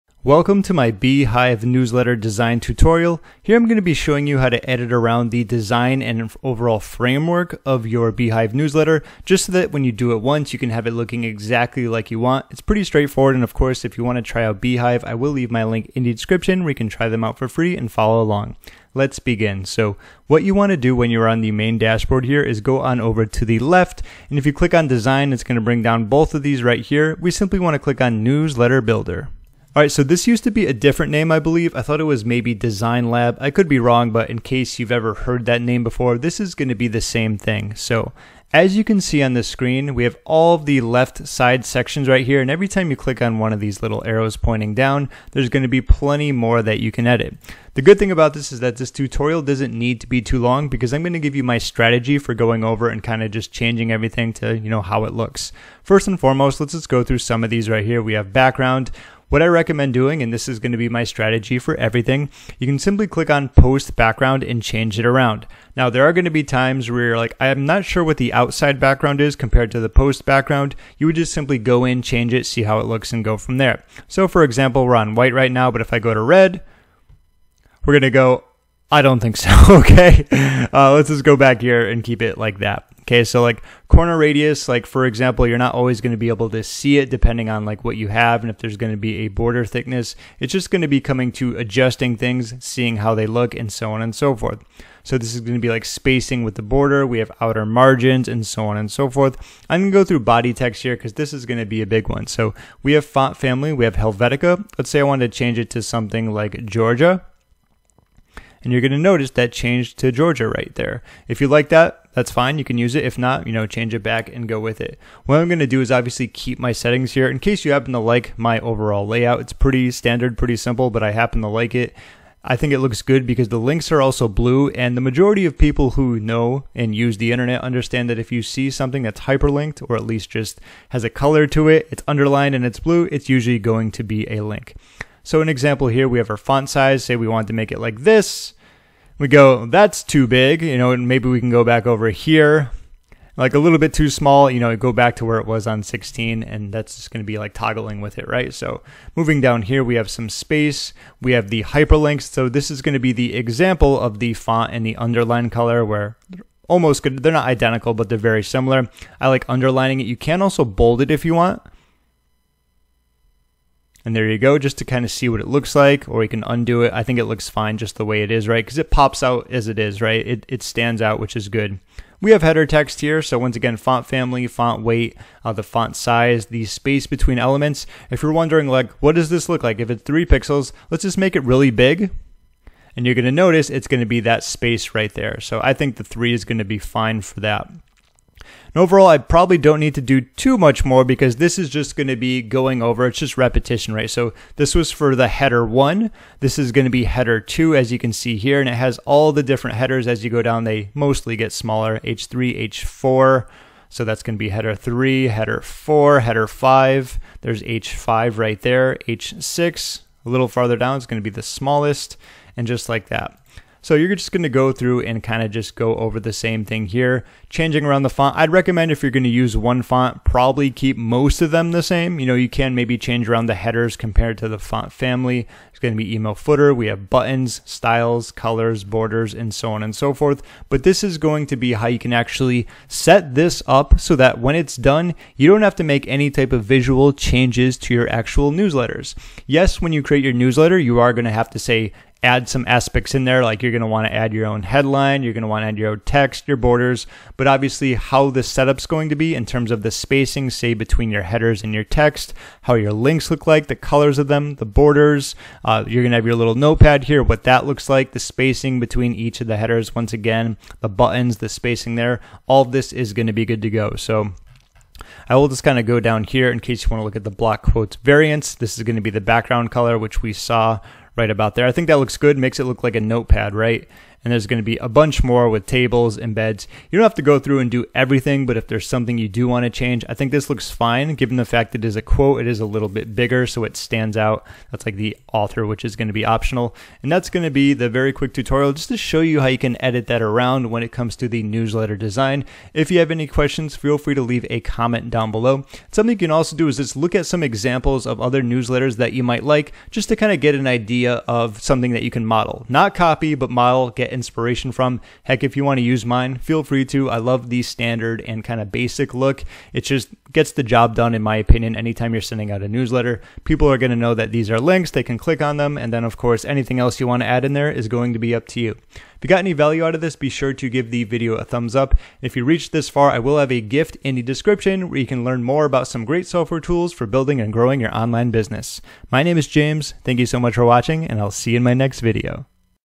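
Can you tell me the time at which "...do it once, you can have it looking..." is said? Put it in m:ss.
0:09.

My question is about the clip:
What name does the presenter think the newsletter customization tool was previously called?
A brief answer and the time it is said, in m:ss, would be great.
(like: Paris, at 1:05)
Design Lab, at 0:32.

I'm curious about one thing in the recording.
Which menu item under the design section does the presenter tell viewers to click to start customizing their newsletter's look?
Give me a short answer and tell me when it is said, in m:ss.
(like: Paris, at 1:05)
Newsletter builder, at 0:28.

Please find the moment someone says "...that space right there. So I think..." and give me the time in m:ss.
3:04.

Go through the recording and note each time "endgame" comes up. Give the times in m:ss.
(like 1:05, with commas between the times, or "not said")
not said.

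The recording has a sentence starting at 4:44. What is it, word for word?
That's like the author, which is going to be optional.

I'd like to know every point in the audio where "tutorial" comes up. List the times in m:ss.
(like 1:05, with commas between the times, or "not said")
0:02, 0:48, 4:48.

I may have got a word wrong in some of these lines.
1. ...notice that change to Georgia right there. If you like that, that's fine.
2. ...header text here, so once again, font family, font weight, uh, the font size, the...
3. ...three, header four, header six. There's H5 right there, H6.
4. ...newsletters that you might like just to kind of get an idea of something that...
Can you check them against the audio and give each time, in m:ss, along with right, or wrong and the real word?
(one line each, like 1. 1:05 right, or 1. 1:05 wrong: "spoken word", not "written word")
1. 1:48 right
2. 2:52 right
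3. 3:24 wrong: "five", not "six"
4. 4:58 right.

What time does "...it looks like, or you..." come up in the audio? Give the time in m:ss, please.
2:45.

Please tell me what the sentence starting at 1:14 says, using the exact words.
So, for example, we're on white right now, but if I go to red, we're going to go, I don't think so.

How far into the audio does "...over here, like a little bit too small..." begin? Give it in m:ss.
2:21.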